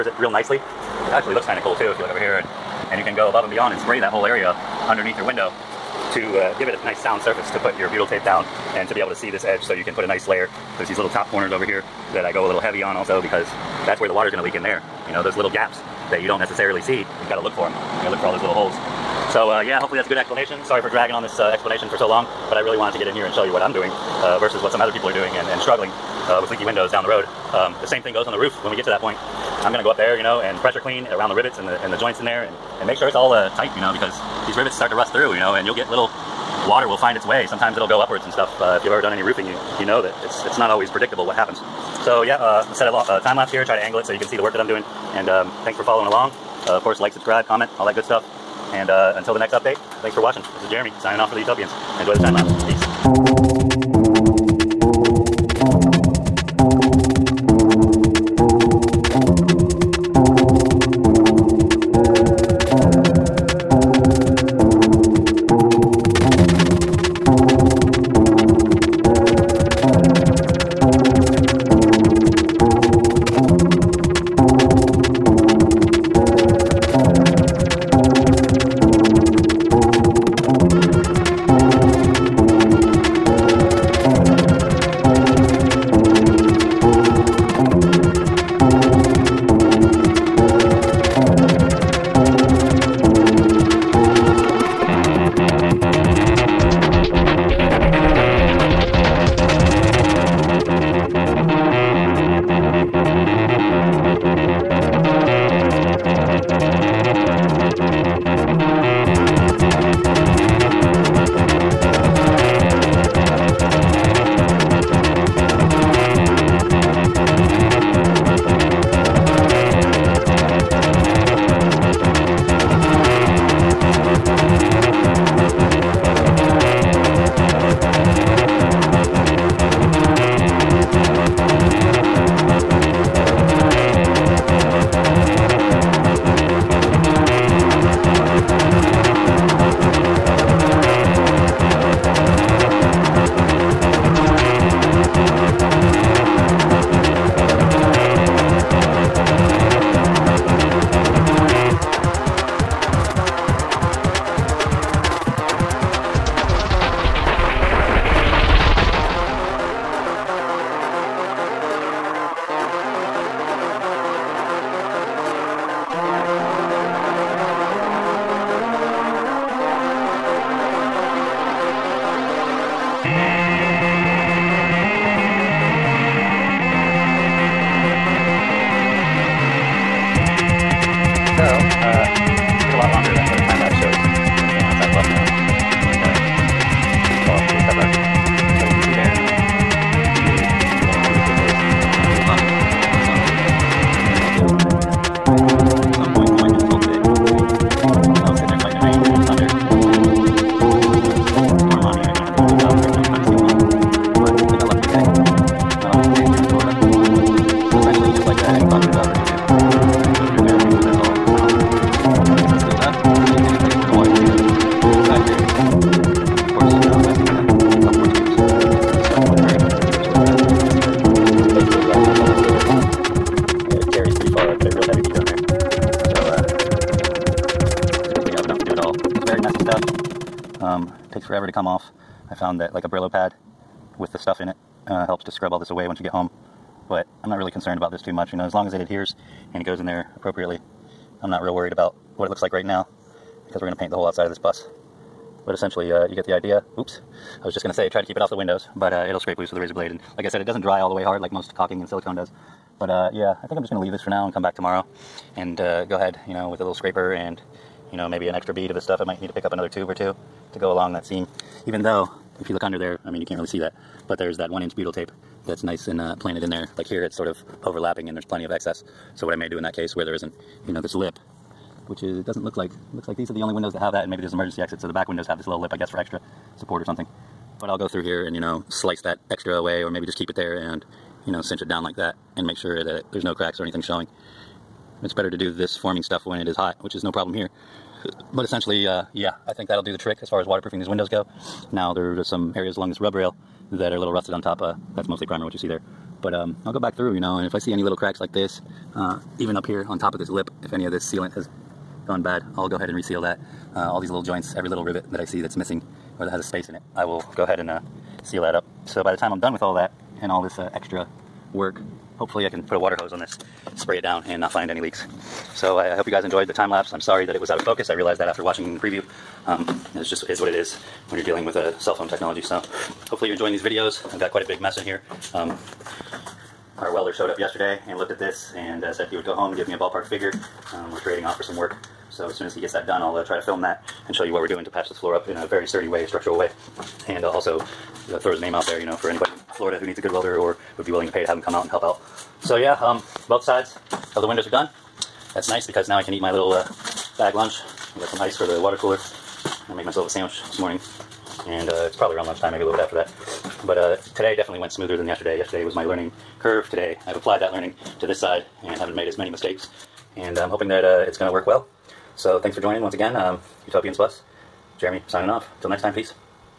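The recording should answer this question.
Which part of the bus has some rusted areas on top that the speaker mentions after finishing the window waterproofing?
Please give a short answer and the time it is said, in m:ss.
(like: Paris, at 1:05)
rub rail, at 4:52.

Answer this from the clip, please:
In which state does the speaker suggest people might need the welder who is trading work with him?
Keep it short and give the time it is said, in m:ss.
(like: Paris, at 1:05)
Florida, at 5:39.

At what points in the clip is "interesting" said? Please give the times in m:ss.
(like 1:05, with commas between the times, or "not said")
not said.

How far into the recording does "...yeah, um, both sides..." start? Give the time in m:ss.
5:42.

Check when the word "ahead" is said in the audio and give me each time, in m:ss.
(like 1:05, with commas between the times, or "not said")
4:15, 5:02, 5:07.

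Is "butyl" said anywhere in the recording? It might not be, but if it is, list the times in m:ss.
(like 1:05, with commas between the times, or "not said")
0:07, 4:24.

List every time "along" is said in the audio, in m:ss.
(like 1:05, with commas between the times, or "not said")
0:46, 4:20, 4:52.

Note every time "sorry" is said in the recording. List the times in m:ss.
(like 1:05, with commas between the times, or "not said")
0:20, 5:17.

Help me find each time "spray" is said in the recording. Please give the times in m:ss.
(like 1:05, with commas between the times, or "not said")
0:03, 5:13.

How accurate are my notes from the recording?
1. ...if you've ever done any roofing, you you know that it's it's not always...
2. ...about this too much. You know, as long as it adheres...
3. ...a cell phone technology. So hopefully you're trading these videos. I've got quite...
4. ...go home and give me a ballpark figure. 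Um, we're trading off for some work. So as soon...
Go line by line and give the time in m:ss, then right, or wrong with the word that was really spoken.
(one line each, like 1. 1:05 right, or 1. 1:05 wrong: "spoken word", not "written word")
1. 0:38 right
2. 3:57 right
3. 5:21 wrong: "enjoying", not "trading"
4. 5:29 right.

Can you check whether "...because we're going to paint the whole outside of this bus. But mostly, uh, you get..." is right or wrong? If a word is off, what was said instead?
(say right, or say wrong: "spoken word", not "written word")
wrong: "essentially", not "mostly".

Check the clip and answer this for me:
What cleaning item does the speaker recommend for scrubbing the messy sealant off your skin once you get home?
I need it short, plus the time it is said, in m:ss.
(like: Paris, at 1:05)
Brillo pad, at 3:52.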